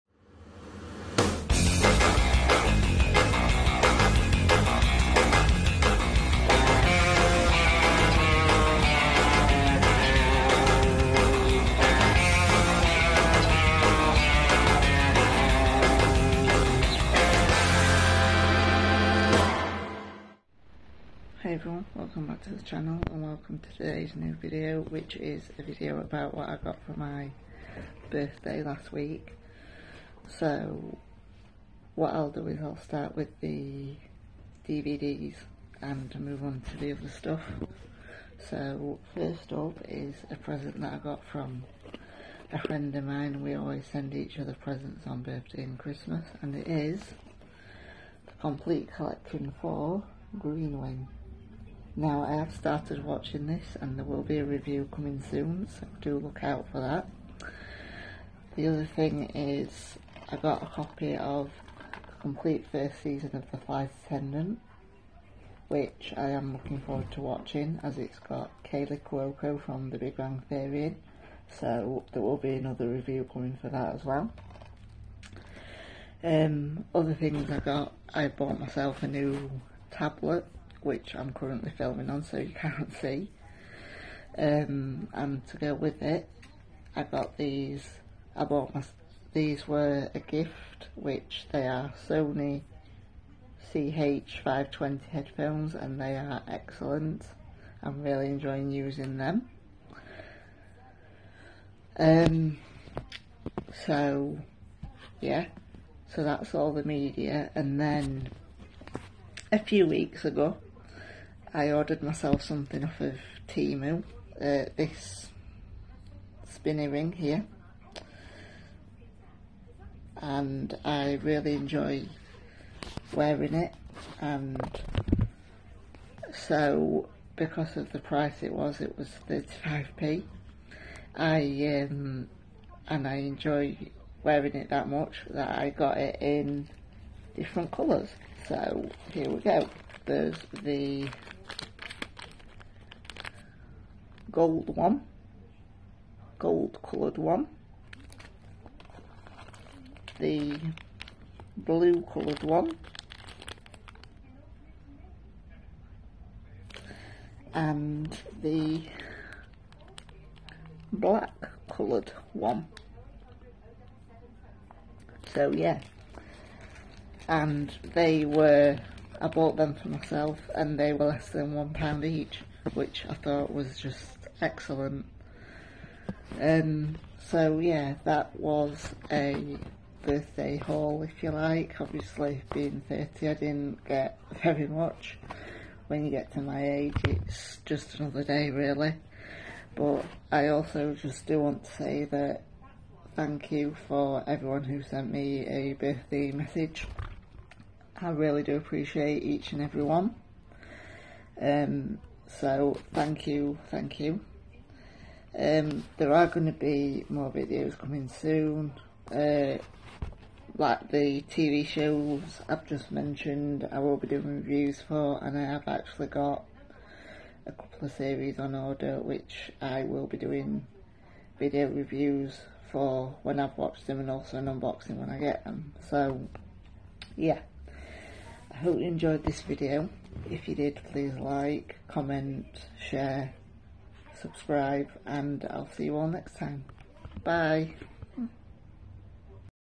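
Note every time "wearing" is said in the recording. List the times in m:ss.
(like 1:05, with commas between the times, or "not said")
2:03, 2:14.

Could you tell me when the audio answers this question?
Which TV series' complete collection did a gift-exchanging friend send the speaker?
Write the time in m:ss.
0:50.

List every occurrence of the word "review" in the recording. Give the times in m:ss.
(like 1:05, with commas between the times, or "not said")
0:54, 1:12, 3:34, 3:41.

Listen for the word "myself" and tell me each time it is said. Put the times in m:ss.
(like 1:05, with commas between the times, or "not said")
1:18, 1:52, 2:49.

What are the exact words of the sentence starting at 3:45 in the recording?
So, yeah hope you enjoyed this video.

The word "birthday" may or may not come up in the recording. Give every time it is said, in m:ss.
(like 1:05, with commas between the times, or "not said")
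0:28, 0:45, 3:00, 3:15.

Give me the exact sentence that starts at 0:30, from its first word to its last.
So what I'll do is I'll start with the DVDs and move on to the other stuff.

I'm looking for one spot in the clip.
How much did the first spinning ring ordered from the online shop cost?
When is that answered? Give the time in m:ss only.
2:09.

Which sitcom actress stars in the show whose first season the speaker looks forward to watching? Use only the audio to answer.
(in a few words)
Kaley Cuoco.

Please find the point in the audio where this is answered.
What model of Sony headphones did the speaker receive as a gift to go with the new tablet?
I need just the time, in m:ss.
1:33.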